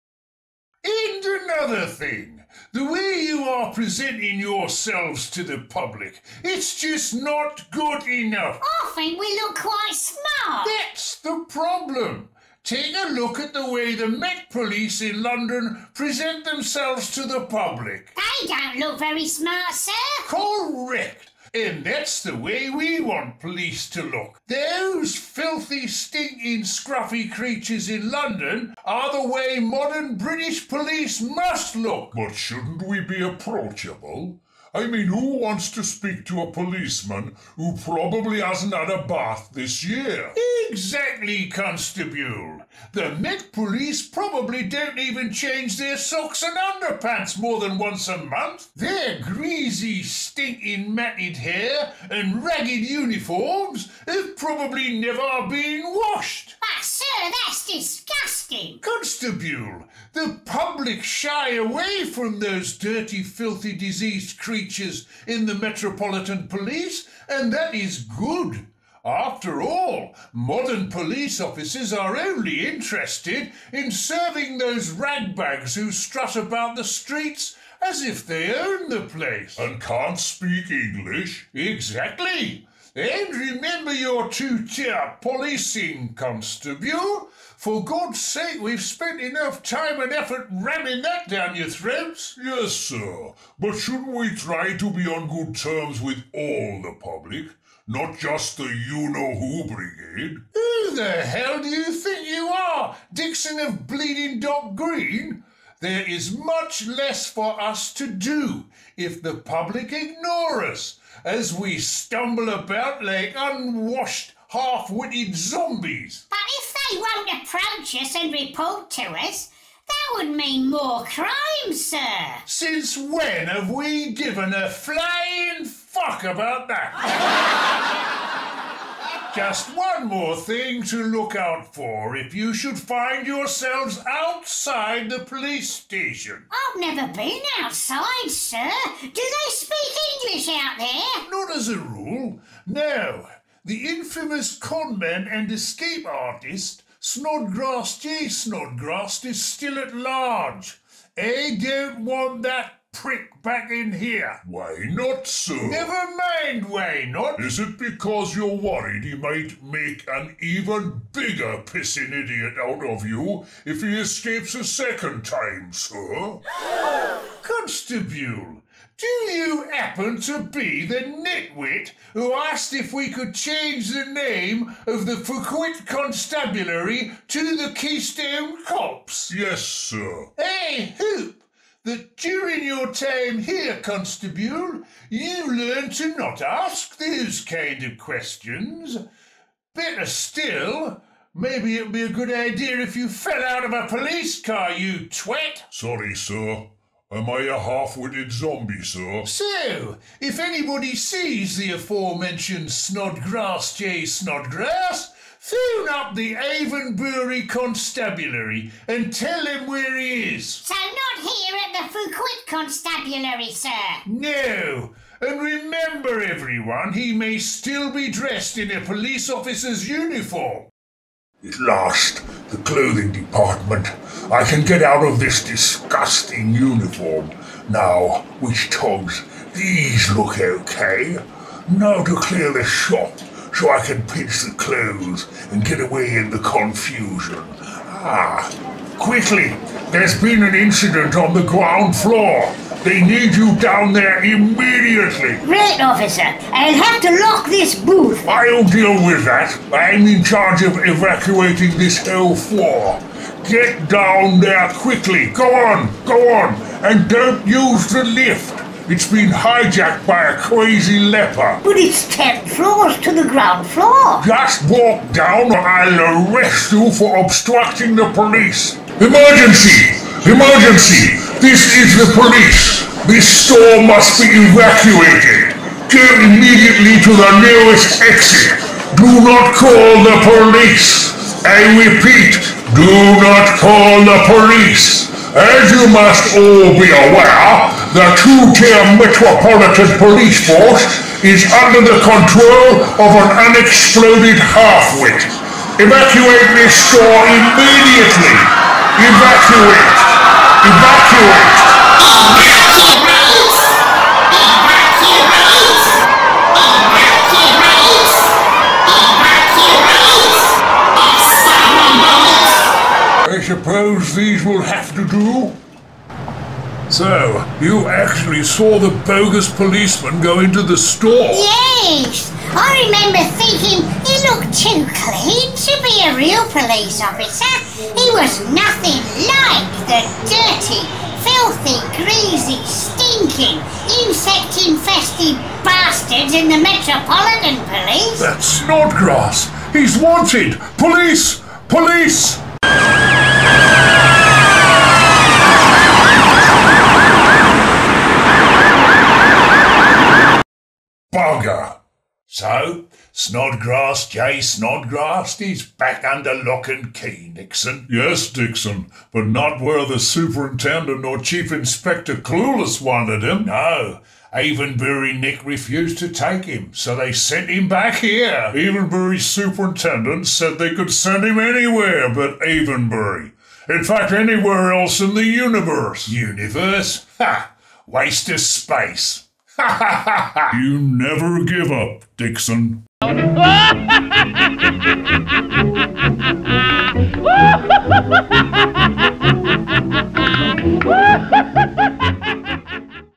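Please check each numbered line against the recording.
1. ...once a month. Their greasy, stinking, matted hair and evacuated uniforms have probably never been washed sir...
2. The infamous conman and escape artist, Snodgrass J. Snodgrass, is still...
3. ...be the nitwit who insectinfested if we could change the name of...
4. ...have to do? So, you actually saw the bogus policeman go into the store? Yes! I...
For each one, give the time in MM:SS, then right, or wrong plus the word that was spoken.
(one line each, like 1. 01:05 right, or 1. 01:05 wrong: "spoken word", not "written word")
1. 00:47 wrong: "ragged", not "evacuated"
2. 02:23 right
3. 02:50 wrong: "asked", not "insectinfested"
4. 05:14 right.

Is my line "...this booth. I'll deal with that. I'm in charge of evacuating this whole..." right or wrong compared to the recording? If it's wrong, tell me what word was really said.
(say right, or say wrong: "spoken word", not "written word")
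right.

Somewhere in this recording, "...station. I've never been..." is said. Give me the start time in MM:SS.
02:15.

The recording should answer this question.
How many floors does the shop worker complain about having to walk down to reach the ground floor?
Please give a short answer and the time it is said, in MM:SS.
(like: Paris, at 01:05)
10, at 04:22.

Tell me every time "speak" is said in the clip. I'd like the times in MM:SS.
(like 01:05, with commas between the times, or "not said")
00:35, 01:20, 02:19.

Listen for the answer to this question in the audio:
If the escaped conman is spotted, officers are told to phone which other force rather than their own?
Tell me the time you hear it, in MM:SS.
03:26.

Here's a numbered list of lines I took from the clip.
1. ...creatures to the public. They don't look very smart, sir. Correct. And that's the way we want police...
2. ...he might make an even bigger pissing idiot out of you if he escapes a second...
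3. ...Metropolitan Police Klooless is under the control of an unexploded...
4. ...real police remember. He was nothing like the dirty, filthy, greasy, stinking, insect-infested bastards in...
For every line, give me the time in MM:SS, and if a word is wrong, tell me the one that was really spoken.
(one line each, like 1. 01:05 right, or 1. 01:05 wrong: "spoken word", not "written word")
1. 00:16 wrong: "themselves", not "creatures"
2. 02:39 right
3. 04:48 wrong: "Force", not "Klooless"
4. 05:26 wrong: "officer", not "remember".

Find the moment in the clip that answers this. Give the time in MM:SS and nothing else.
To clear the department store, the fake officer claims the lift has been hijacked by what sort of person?
04:20.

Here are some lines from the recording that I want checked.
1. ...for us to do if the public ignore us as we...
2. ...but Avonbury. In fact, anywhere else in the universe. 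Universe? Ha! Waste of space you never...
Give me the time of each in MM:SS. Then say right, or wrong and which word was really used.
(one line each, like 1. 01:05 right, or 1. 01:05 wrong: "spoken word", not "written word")
1. 01:47 right
2. 06:12 right.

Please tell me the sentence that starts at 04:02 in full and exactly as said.
They need you down there immediately.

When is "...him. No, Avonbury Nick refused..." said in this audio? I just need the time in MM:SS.
06:03.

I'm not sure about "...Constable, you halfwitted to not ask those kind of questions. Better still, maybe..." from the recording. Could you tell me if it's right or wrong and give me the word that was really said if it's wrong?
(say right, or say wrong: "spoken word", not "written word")
wrong: "learned", not "halfwitted".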